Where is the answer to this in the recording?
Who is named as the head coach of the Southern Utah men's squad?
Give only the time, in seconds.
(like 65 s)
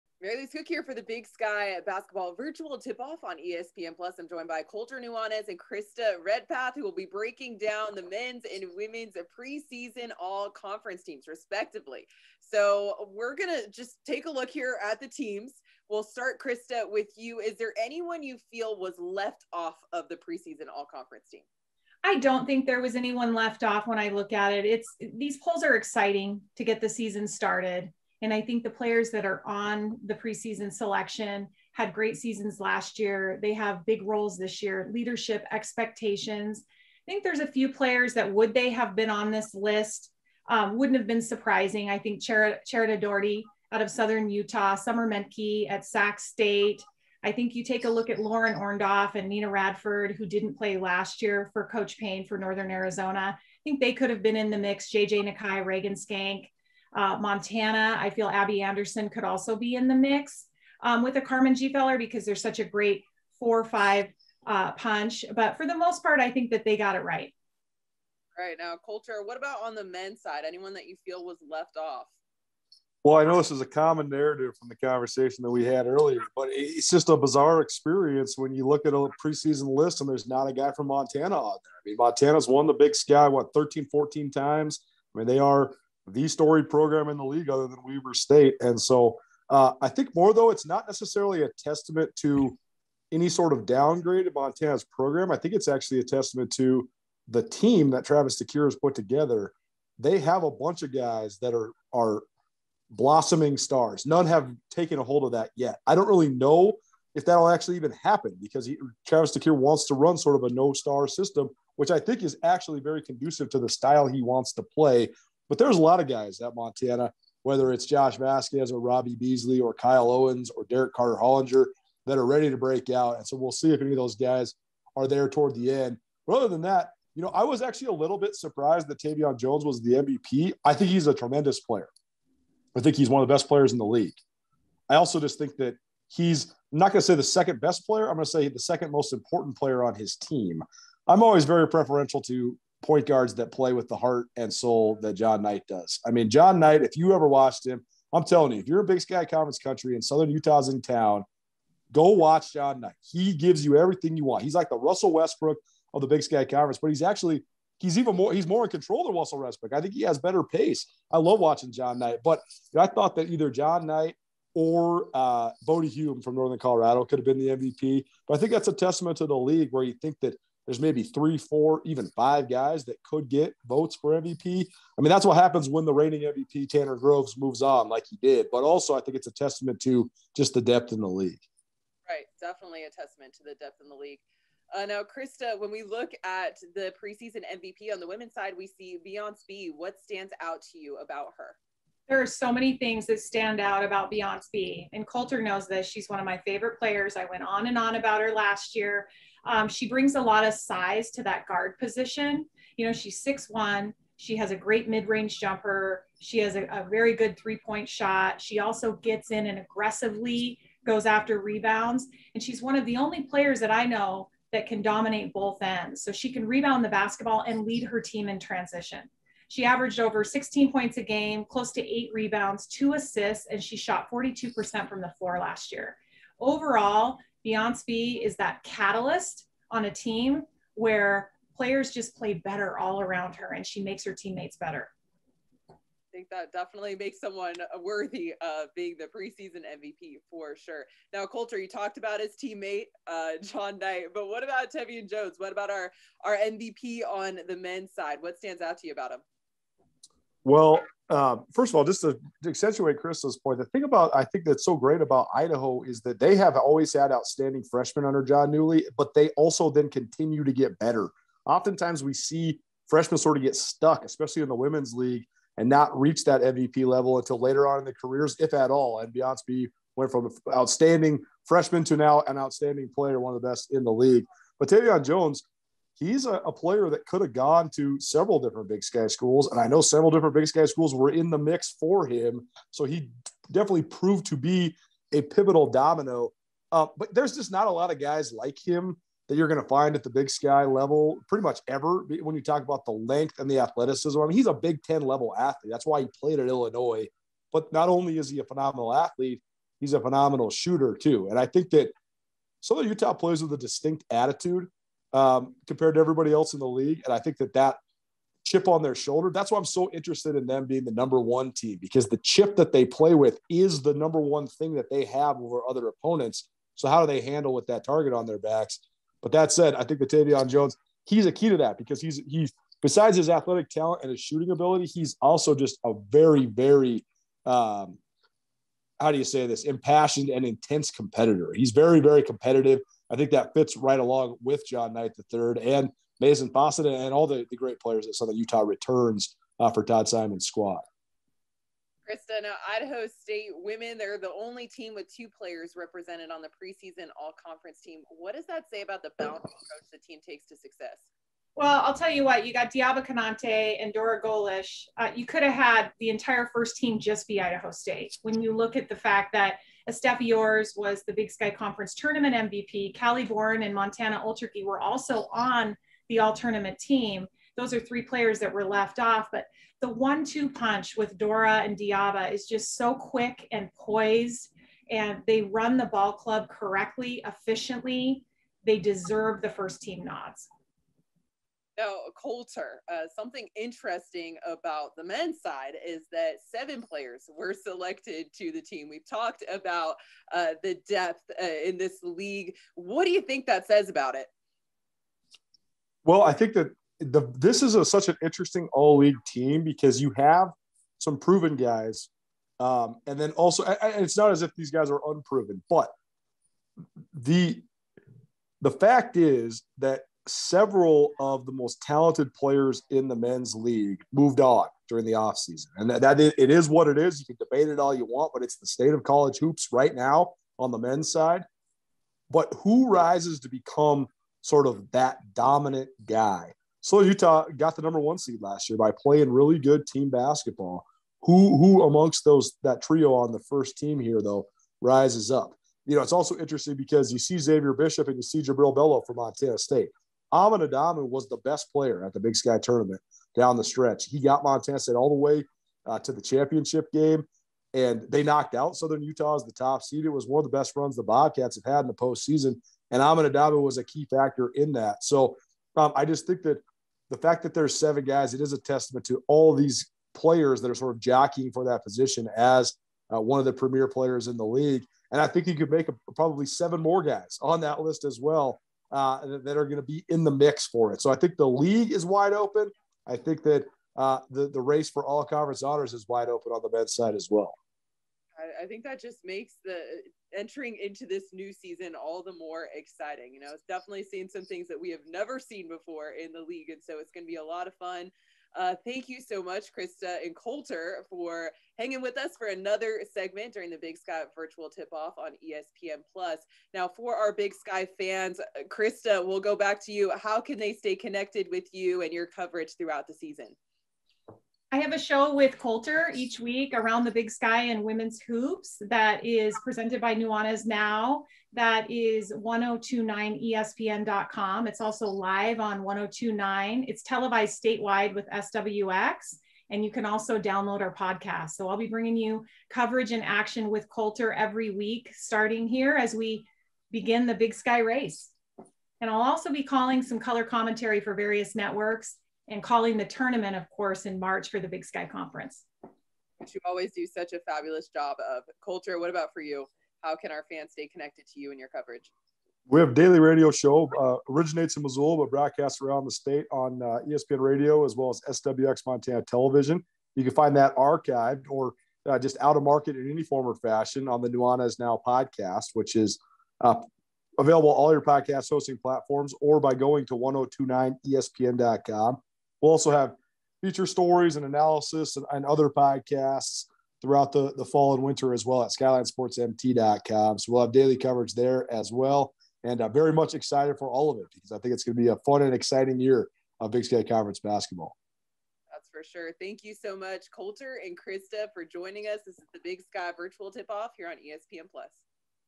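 339 s.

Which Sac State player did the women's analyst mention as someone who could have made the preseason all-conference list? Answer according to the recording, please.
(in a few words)
Summer Menke.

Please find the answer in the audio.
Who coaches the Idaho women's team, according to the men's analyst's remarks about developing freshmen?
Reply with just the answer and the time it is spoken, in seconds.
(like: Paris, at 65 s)
Jon Newlee, at 258 s.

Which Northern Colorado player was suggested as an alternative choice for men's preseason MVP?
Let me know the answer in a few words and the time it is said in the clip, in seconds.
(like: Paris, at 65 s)
Bodie Hume, at 165 s.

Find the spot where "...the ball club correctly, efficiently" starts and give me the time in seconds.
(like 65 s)
375 s.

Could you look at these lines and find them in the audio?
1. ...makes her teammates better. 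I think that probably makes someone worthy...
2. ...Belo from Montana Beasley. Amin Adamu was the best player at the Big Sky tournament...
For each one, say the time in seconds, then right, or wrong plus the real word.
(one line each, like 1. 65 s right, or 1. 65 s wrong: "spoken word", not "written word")
1. 233 s wrong: "definitely", not "probably"
2. 438 s wrong: "State", not "Beasley".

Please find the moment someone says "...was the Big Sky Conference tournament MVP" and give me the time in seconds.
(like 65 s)
360 s.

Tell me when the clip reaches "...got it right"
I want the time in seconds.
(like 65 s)
66 s.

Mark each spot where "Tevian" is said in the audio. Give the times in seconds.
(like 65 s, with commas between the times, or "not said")
128 s, 244 s, 274 s, 320 s.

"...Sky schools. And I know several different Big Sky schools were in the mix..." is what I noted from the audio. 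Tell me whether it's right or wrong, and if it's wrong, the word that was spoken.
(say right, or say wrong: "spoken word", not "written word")
right.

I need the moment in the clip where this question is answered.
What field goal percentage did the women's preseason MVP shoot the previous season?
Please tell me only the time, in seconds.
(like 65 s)
224 s.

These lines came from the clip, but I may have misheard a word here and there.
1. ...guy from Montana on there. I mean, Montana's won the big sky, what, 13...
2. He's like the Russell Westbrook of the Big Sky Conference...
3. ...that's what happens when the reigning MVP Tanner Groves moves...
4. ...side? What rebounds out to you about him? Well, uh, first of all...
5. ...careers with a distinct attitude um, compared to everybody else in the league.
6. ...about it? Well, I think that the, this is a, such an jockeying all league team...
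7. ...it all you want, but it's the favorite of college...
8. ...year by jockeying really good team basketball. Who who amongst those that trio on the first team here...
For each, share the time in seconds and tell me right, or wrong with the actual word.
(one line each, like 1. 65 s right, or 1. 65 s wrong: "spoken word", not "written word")
1. 80 s right
2. 154 s right
3. 175 s right
4. 247 s wrong: "stands", not "rebounds"
5. 303 s wrong: "players", not "careers"
6. 393 s wrong: "interesting", not "jockeying"
7. 417 s wrong: "state", not "favorite"
8. 428 s wrong: "playing", not "jockeying".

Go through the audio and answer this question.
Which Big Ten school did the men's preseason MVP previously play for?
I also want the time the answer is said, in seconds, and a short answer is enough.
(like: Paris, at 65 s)
Illinois, at 296 s.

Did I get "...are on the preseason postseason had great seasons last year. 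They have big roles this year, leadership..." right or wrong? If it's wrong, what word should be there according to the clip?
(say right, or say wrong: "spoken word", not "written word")
wrong: "selection", not "postseason".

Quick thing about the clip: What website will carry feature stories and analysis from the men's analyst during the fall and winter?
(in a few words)
skylinesportsmt.com.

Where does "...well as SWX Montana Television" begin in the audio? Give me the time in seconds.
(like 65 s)
547 s.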